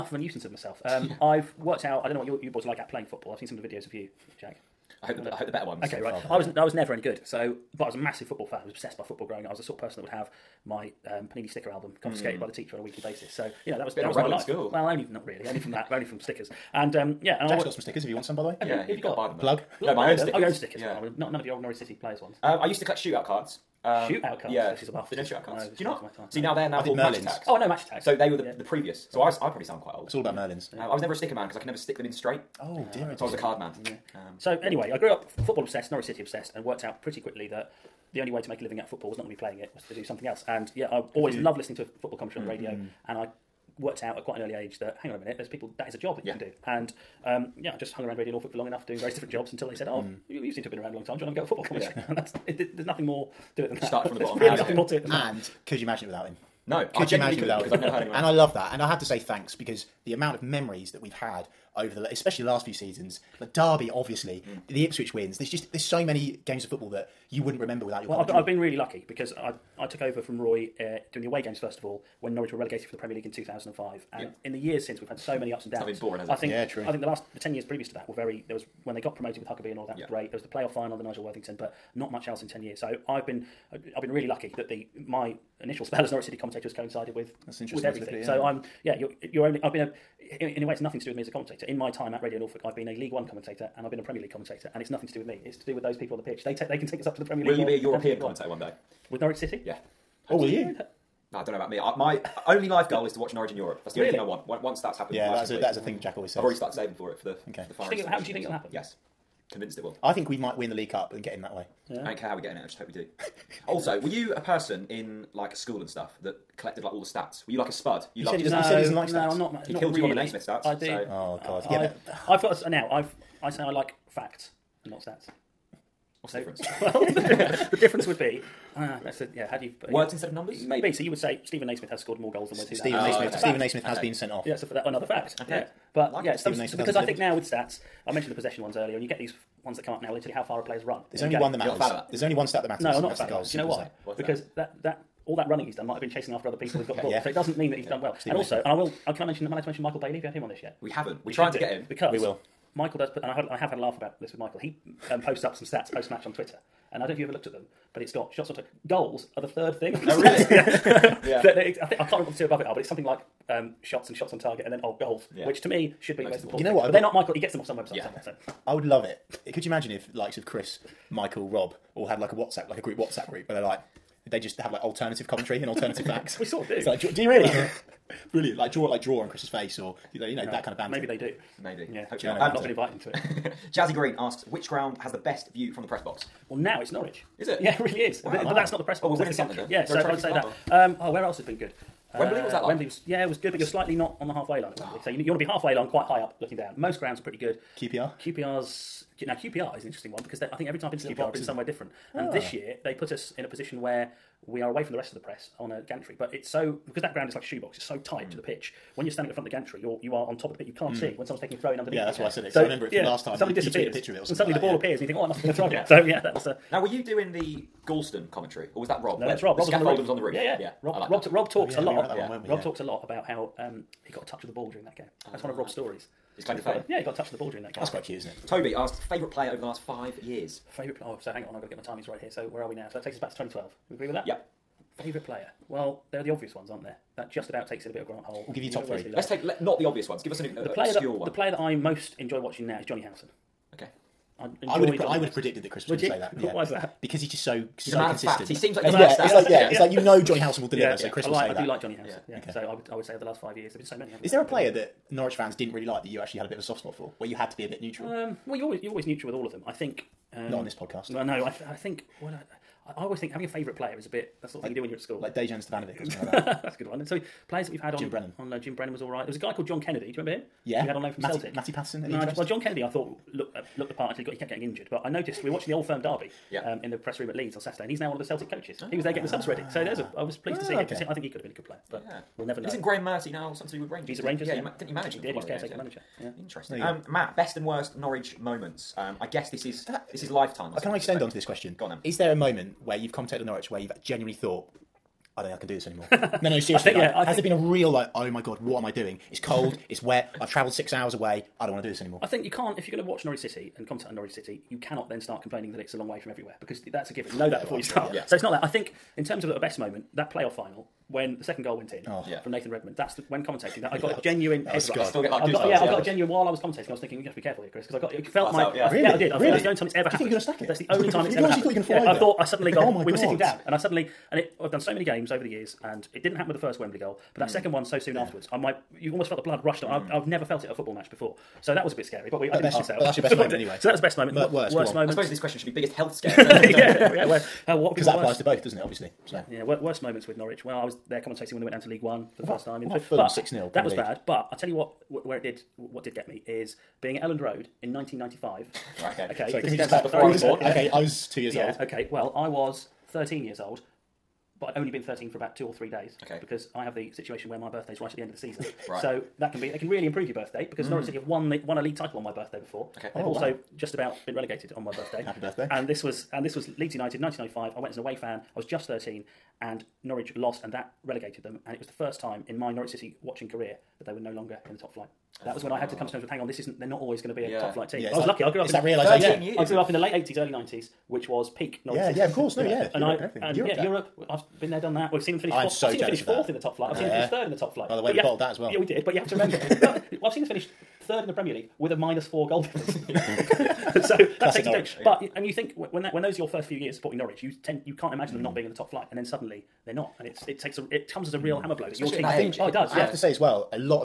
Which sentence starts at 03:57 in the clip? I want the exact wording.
That just about takes in a bit of Grant Holt.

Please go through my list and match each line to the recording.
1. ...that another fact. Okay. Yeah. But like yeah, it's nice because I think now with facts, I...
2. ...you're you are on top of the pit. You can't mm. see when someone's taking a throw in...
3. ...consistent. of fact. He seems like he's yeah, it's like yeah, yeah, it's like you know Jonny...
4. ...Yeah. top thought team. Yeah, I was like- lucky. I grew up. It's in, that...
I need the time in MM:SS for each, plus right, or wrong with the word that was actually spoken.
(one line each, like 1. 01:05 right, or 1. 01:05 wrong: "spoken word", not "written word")
1. 02:14 wrong: "stats", not "facts"
2. 03:29 right
3. 04:08 right
4. 06:17 wrong: "flight", not "thought".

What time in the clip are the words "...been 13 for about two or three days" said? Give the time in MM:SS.
05:54.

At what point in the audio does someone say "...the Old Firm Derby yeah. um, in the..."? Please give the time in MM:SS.
04:35.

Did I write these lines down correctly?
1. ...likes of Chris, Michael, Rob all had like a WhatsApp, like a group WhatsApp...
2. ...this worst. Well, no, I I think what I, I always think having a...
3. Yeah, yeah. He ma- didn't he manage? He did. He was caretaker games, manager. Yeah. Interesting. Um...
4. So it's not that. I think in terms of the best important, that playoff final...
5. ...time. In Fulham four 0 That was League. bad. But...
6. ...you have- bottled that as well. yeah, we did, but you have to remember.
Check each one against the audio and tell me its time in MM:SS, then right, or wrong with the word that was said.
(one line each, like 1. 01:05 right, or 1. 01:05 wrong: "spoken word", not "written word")
1. 02:50 right
2. 04:20 wrong: "podcast", not "worst"
3. 04:44 right
4. 05:08 wrong: "moment", not "important"
5. 05:42 wrong: "six", not "four"
6. 06:28 right.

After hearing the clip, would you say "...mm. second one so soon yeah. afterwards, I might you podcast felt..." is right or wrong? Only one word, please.
wrong.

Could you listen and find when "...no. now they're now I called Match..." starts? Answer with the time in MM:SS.
00:26.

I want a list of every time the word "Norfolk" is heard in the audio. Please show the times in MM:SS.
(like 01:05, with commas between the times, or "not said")
00:48, 01:32.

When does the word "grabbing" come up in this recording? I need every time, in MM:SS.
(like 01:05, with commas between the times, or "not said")
not said.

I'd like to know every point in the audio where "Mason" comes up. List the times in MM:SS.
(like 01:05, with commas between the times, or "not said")
02:28.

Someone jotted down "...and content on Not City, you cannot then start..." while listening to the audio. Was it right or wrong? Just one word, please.
wrong.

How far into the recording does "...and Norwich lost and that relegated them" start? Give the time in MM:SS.
06:09.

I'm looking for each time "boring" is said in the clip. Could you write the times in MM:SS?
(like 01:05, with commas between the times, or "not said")
01:16.